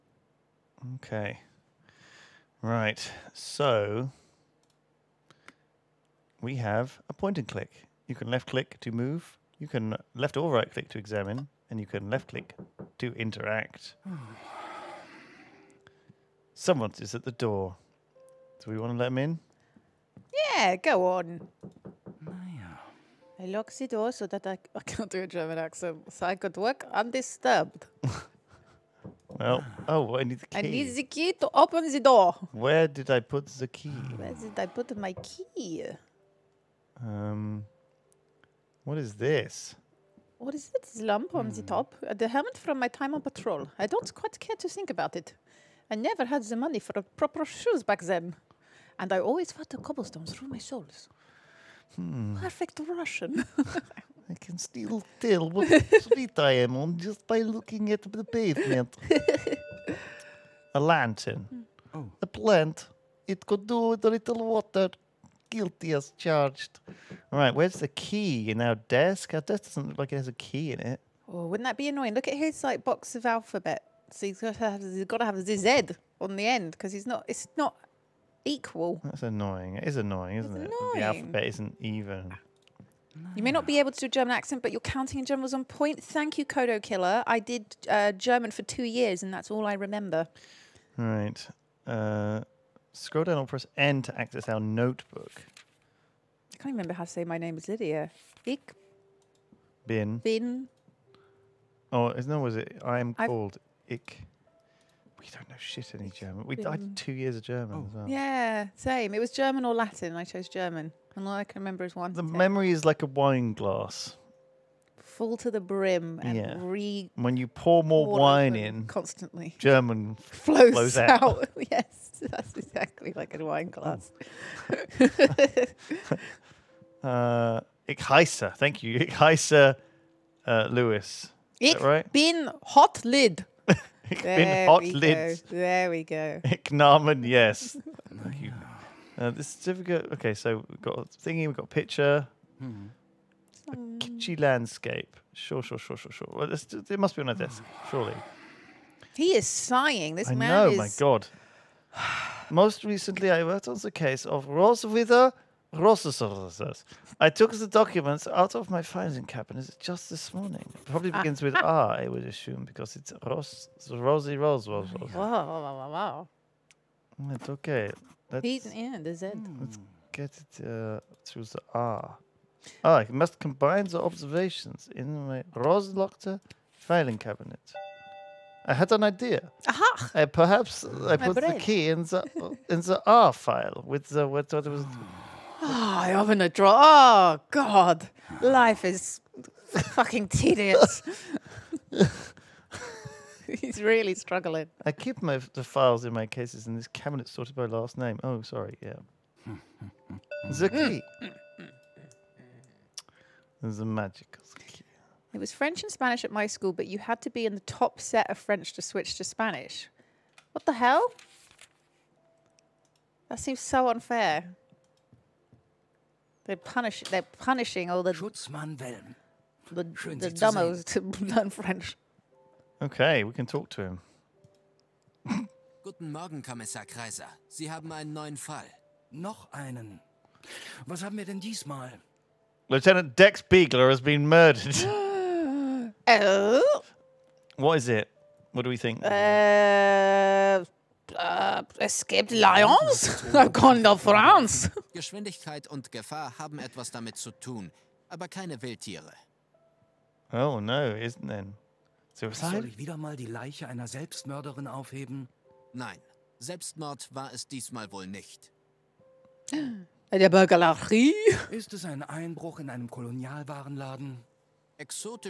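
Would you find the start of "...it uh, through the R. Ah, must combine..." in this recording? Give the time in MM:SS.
02:50.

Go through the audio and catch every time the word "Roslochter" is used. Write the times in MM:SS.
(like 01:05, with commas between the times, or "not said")
02:55.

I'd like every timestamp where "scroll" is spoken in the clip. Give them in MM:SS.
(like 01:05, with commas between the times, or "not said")
01:32.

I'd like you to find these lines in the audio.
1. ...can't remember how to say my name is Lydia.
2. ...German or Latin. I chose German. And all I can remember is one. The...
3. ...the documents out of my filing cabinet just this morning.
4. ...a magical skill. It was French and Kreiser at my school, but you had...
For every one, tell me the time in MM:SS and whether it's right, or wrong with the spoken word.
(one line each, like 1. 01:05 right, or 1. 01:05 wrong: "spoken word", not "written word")
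1. 01:36 right
2. 01:49 right
3. 02:37 right
4. 03:23 wrong: "Spanish", not "Kreiser".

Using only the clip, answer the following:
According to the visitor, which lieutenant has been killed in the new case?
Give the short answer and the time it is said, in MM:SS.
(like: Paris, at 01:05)
Dex Beagler, at 03:53.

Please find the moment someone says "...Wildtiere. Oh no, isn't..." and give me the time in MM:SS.
04:08.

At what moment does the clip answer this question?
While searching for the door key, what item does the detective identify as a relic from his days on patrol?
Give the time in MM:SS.
00:42.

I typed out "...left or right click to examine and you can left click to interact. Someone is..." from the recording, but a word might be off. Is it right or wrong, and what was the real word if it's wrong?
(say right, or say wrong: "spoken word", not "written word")
right.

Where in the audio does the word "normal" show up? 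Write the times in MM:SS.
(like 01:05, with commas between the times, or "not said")
not said.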